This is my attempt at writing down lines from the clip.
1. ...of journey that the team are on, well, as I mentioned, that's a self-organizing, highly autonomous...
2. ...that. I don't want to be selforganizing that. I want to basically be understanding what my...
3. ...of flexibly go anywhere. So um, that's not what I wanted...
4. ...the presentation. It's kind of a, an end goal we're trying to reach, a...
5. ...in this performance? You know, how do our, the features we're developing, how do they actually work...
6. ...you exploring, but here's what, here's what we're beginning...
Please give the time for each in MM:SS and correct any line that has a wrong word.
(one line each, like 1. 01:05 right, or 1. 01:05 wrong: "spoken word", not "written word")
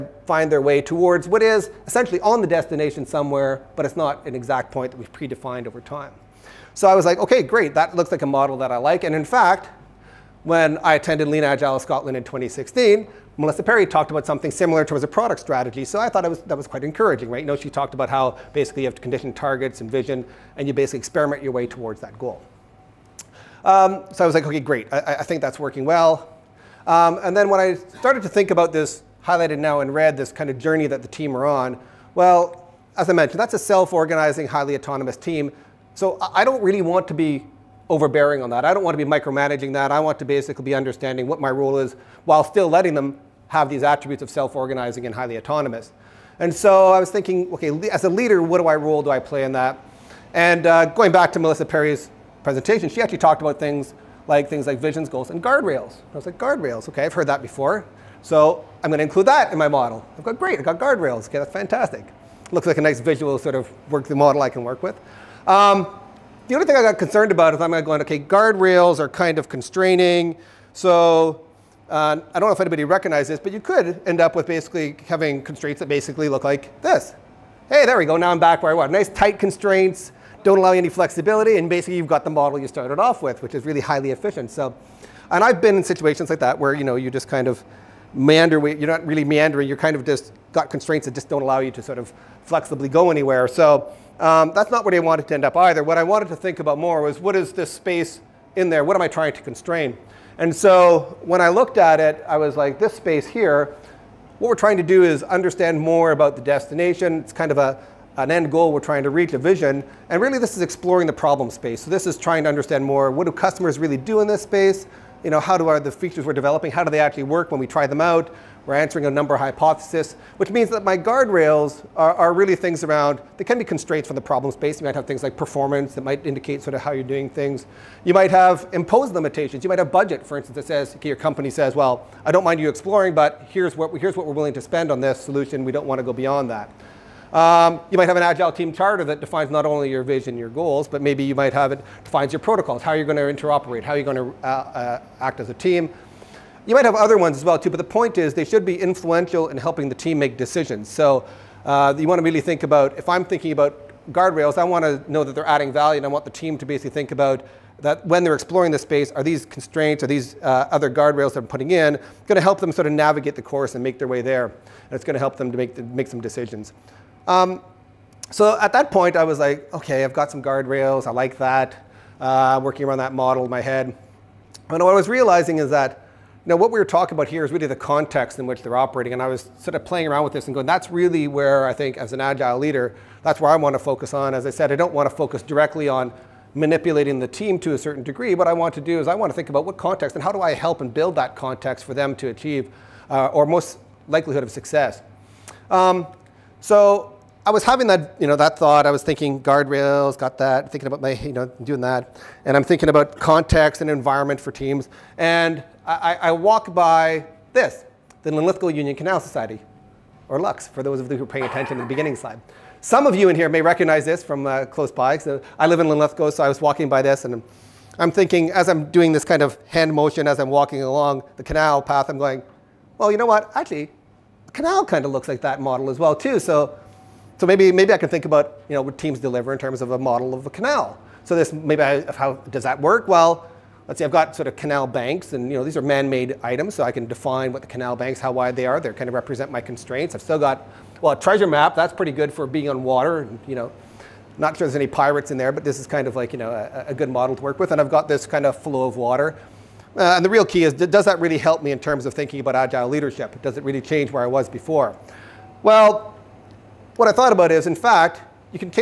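1. 00:30 right
2. 00:38 wrong: "micromanaging", not "selforganizing"
3. 01:31 right
4. 01:46 wrong: "destination", not "presentation"
5. 01:54 wrong: "space", not "performance"
6. 02:12 wrong: "willing", not "beginning".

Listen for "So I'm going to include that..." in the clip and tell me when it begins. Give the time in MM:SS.
00:58.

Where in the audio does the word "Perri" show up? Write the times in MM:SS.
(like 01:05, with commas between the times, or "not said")
00:13, 00:51.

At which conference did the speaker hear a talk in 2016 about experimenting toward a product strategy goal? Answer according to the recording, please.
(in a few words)
Lean Agile Scotland.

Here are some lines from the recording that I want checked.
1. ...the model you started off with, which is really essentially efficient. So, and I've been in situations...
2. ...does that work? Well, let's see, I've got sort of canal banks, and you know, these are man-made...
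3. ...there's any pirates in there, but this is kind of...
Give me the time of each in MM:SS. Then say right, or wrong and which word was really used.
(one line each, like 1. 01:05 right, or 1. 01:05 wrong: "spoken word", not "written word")
1. 01:22 wrong: "highly", not "essentially"
2. 03:52 right
3. 04:04 right.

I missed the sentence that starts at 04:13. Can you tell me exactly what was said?
Does it really change where I was before?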